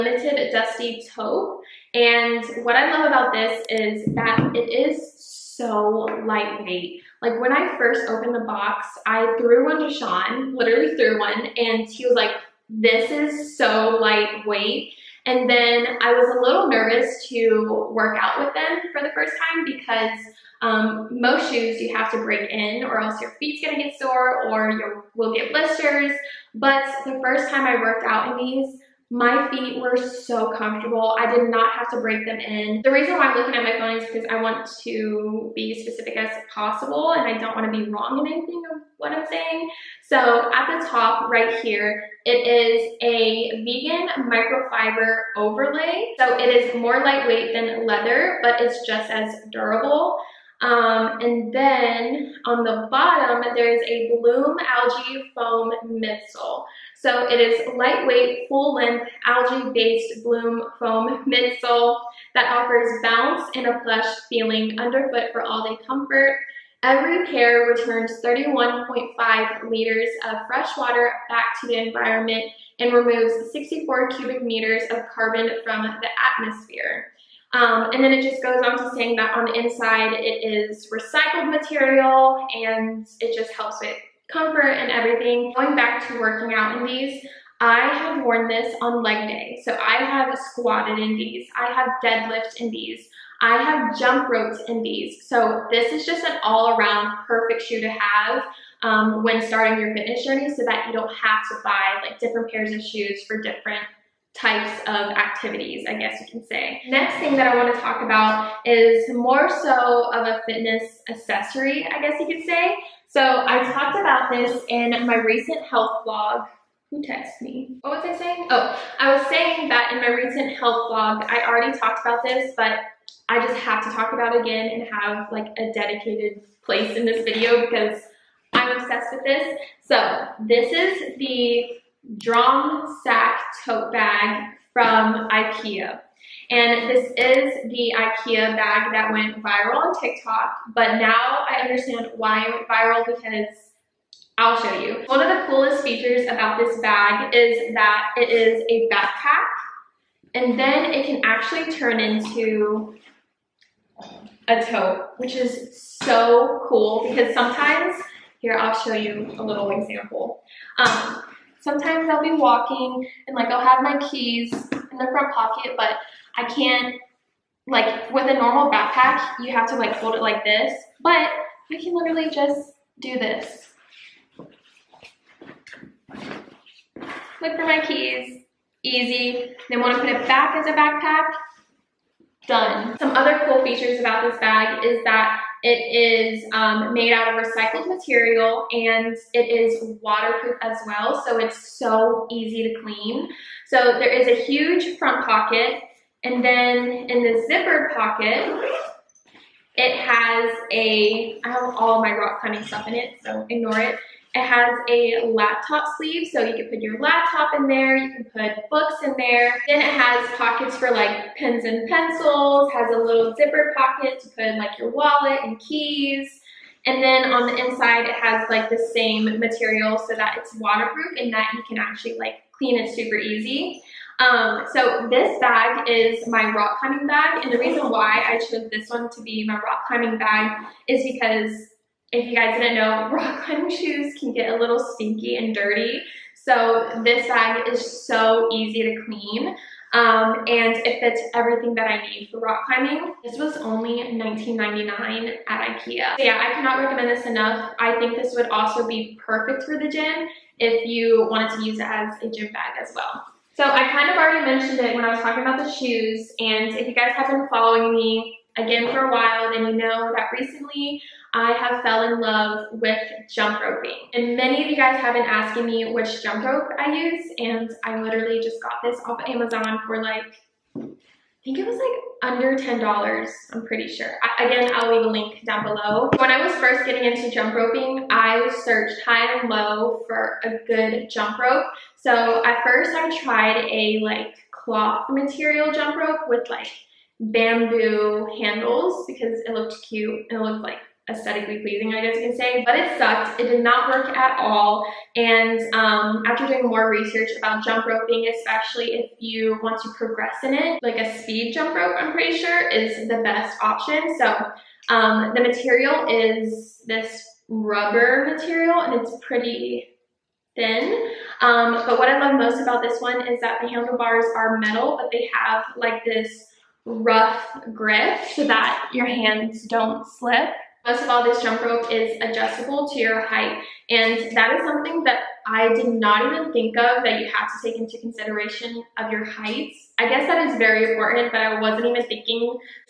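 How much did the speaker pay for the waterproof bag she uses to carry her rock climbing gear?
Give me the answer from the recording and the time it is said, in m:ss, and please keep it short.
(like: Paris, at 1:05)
$19.99, at 4:04.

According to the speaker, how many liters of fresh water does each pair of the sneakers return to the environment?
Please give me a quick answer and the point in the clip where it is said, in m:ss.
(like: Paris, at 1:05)
31.5 liters, at 1:08.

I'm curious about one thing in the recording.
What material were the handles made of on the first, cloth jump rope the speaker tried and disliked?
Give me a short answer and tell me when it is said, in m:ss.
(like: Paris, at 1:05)
bamboo, at 4:47.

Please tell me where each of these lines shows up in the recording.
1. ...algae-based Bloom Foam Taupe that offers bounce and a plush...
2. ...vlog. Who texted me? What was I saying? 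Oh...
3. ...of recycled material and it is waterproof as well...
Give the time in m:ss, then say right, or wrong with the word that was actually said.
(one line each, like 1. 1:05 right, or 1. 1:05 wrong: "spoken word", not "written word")
1. 0:59 wrong: "Midsole", not "Taupe"
2. 1:56 right
3. 3:07 right.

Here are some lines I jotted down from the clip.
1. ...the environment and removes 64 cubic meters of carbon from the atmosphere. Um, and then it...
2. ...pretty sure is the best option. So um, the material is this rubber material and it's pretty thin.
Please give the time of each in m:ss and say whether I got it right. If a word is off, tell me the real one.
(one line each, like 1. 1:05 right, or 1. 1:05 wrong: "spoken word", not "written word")
1. 1:11 right
2. 5:02 right.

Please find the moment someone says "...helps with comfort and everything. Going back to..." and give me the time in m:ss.
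1:23.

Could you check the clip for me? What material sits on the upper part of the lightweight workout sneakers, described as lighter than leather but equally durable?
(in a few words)
vegan microfiber.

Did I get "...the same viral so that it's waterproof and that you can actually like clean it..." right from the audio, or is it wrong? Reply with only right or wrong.
wrong.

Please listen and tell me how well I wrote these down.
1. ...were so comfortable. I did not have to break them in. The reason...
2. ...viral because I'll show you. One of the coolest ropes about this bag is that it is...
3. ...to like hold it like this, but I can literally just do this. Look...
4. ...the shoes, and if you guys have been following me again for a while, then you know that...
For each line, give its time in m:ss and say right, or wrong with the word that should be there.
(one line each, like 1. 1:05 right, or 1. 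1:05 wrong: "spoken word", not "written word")
1. 0:29 right
2. 2:22 wrong: "features", not "ropes"
3. 2:49 right
4. 4:15 right.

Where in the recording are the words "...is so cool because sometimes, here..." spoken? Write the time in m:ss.
2:35.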